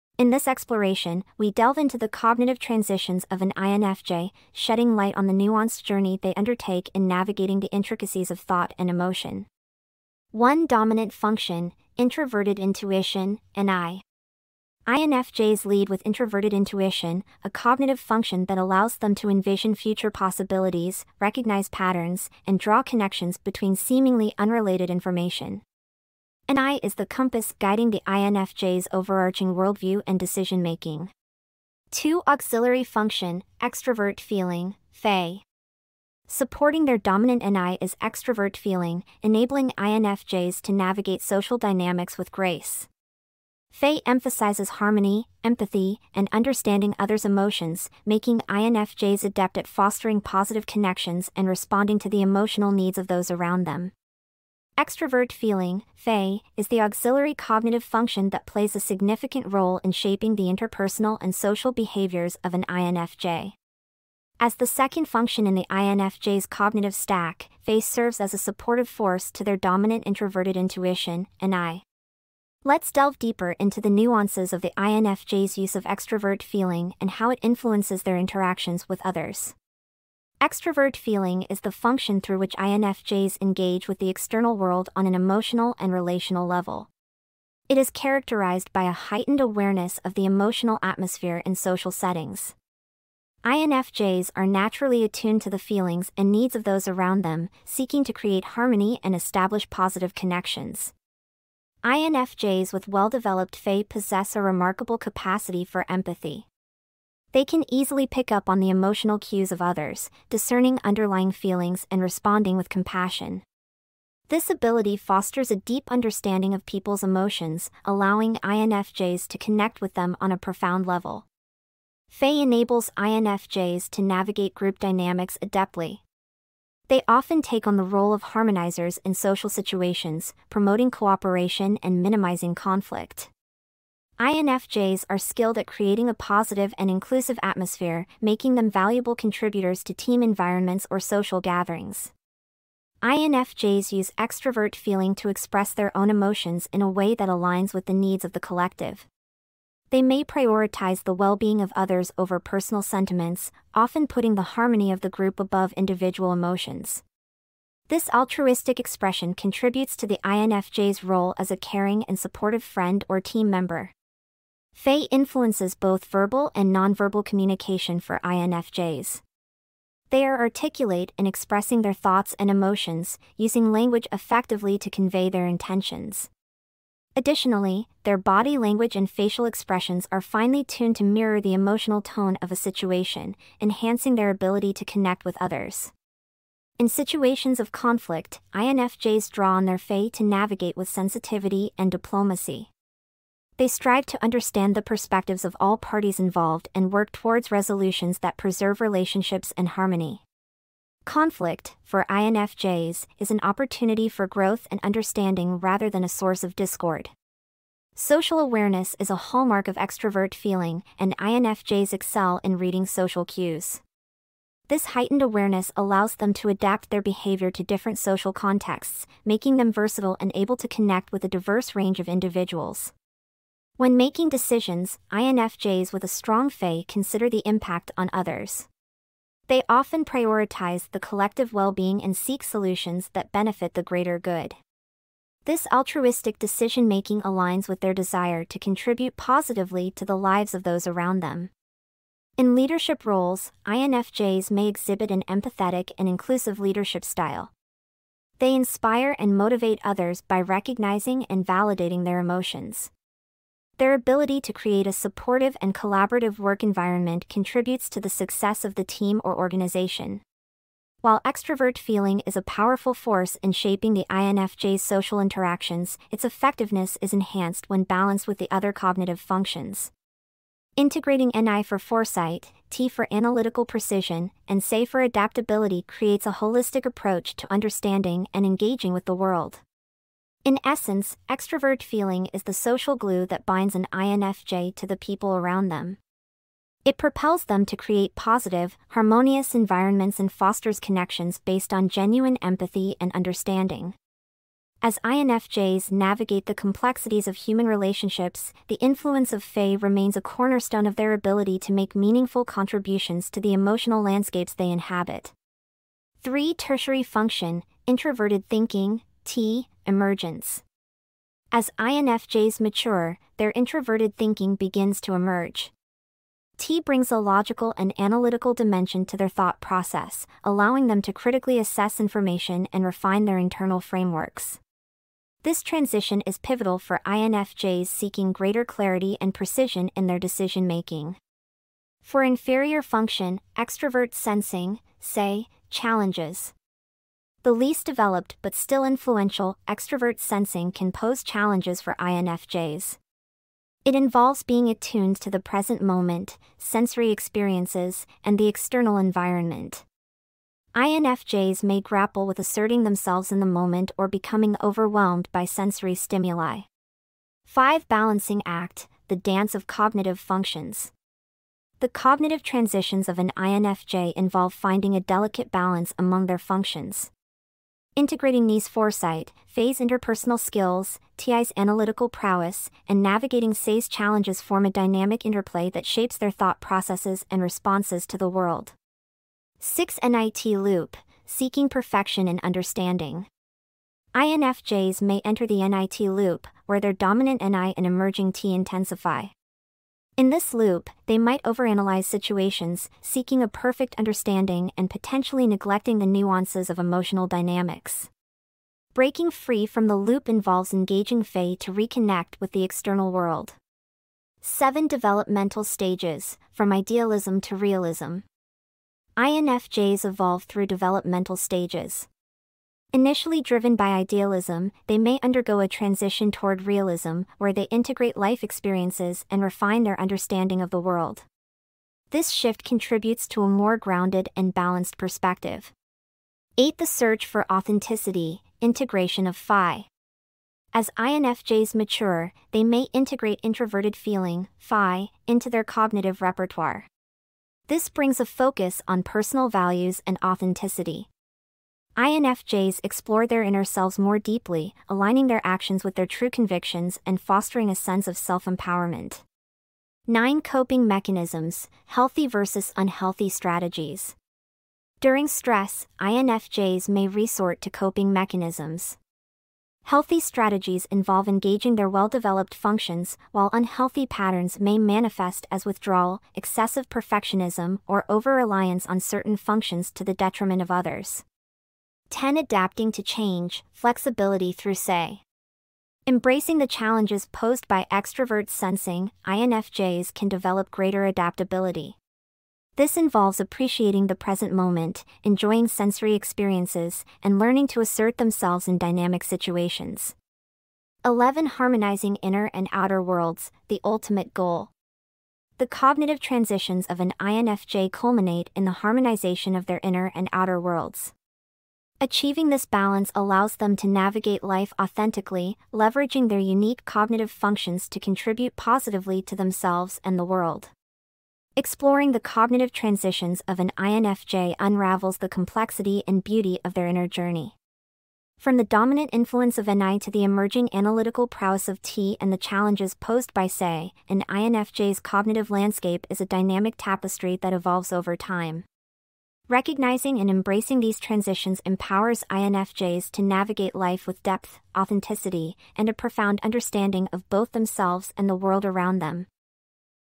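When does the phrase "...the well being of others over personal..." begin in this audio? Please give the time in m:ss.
2:31.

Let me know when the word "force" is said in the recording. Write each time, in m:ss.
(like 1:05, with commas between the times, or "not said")
1:08, 4:22.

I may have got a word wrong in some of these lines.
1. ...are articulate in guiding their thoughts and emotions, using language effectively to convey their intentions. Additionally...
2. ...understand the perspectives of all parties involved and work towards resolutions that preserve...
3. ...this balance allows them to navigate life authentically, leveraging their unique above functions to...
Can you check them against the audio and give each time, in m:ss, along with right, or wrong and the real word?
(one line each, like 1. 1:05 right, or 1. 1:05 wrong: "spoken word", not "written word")
1. 2:50 wrong: "expressing", not "guiding"
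2. 3:14 right
3. 8:22 wrong: "cognitive", not "above".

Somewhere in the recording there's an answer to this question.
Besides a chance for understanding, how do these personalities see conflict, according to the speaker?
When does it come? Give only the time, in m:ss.
3:23.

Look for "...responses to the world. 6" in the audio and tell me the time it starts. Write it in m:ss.
6:17.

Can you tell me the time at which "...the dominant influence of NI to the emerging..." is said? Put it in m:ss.
8:38.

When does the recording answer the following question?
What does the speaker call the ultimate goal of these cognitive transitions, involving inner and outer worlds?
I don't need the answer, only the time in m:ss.
8:11.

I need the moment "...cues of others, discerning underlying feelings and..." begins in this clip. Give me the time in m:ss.
1:49.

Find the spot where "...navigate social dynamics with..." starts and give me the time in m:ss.
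0:40.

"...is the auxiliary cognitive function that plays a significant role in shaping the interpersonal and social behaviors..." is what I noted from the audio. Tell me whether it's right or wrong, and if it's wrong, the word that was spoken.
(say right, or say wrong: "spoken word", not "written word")
right.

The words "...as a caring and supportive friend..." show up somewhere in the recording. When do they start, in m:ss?
2:41.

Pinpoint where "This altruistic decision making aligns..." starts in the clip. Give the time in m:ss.
3:55.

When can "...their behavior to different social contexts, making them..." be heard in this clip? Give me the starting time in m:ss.
3:36.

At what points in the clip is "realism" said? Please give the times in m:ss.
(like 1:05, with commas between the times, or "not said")
6:47, 6:56.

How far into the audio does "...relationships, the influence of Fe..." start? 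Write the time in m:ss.
4:57.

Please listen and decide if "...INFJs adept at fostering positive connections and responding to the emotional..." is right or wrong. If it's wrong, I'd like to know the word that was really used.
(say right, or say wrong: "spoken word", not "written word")
right.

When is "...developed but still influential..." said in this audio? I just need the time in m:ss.
5:37.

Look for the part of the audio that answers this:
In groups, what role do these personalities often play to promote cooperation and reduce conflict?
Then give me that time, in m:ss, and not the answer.
2:08.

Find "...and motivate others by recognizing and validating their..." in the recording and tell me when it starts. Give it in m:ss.
4:09.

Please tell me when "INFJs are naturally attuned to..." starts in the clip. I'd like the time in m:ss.
1:33.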